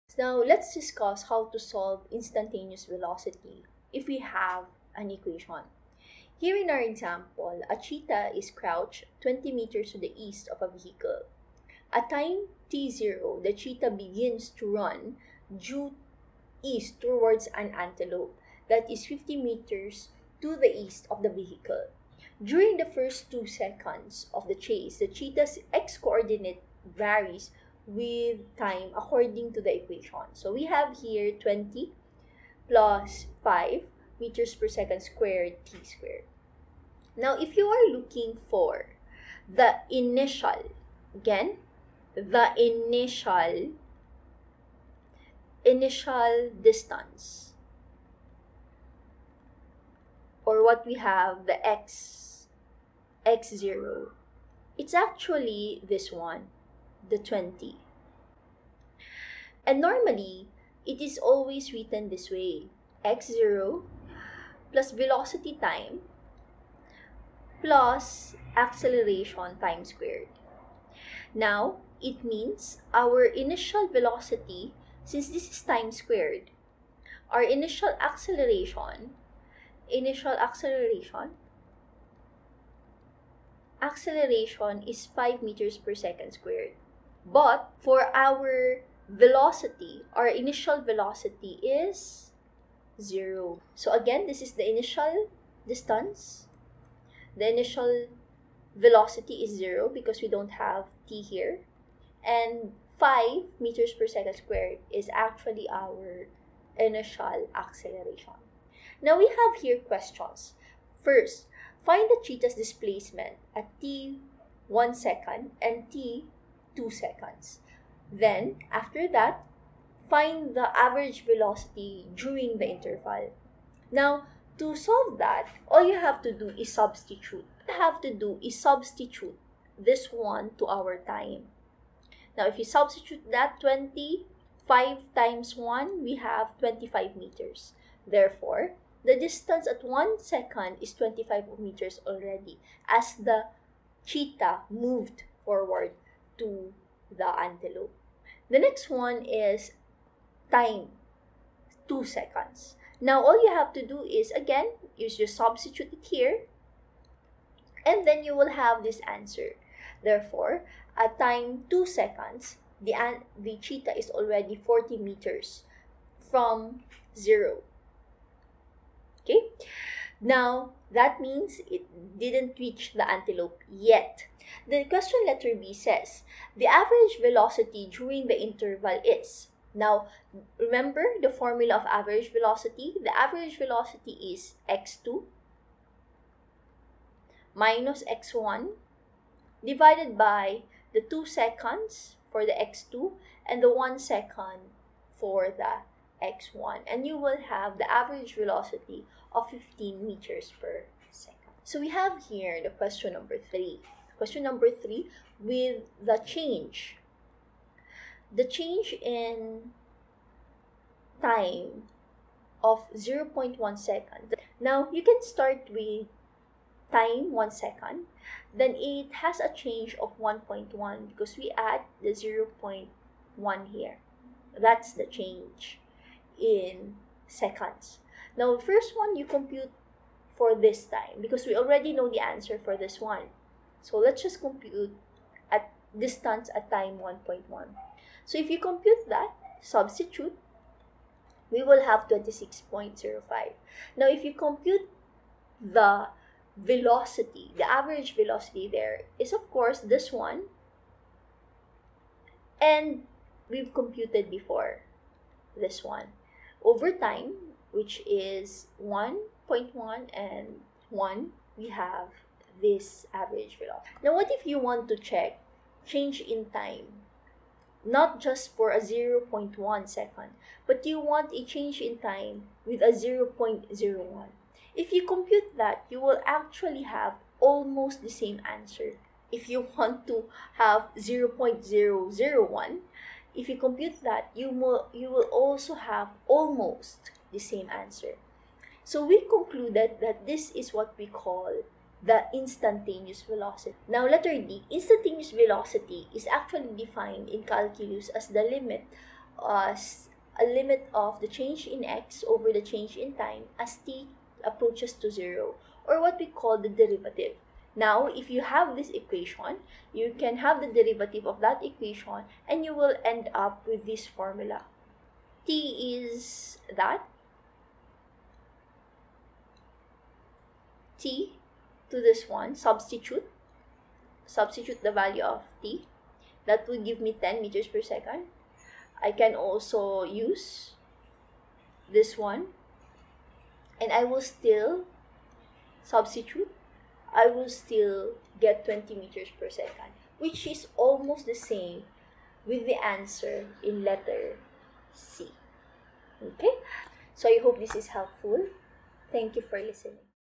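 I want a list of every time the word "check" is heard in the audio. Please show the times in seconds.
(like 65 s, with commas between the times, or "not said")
264 s.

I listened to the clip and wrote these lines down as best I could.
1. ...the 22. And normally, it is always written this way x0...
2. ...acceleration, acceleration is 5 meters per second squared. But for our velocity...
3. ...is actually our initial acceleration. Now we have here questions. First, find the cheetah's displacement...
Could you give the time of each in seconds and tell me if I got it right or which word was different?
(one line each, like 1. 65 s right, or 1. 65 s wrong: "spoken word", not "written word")
1. 57 s wrong: "20", not "22"
2. 80 s right
3. 104 s right.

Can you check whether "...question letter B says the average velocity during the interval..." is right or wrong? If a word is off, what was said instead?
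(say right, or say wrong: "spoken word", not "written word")
right.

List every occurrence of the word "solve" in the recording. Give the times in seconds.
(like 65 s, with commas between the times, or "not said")
1 s, 124 s.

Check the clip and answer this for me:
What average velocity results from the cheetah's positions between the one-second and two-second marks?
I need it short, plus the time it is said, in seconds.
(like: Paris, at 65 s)
15 meters per second, at 199 s.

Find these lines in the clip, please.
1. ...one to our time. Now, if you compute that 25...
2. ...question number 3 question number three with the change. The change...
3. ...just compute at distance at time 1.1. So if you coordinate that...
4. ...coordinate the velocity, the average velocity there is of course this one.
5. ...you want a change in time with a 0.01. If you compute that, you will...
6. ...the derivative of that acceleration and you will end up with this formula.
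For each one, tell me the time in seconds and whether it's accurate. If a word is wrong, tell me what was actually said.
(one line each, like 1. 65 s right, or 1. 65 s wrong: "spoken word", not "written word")
1. 130 s wrong: "substitute", not "compute"
2. 202 s right
3. 234 s wrong: "compute", not "coordinate"
4. 244 s wrong: "compute", not "coordinate"
5. 270 s right
6. 310 s wrong: "equation", not "acceleration".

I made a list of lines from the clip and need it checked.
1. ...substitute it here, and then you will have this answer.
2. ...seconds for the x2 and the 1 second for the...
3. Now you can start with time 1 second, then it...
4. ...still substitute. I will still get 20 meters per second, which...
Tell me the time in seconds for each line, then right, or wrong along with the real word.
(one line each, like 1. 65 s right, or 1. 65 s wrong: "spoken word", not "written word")
1. 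155 s right
2. 191 s right
3. 214 s right
4. 334 s right.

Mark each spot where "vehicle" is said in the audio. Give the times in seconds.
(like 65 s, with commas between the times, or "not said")
10 s, 21 s.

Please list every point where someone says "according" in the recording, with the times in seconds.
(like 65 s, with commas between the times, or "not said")
28 s.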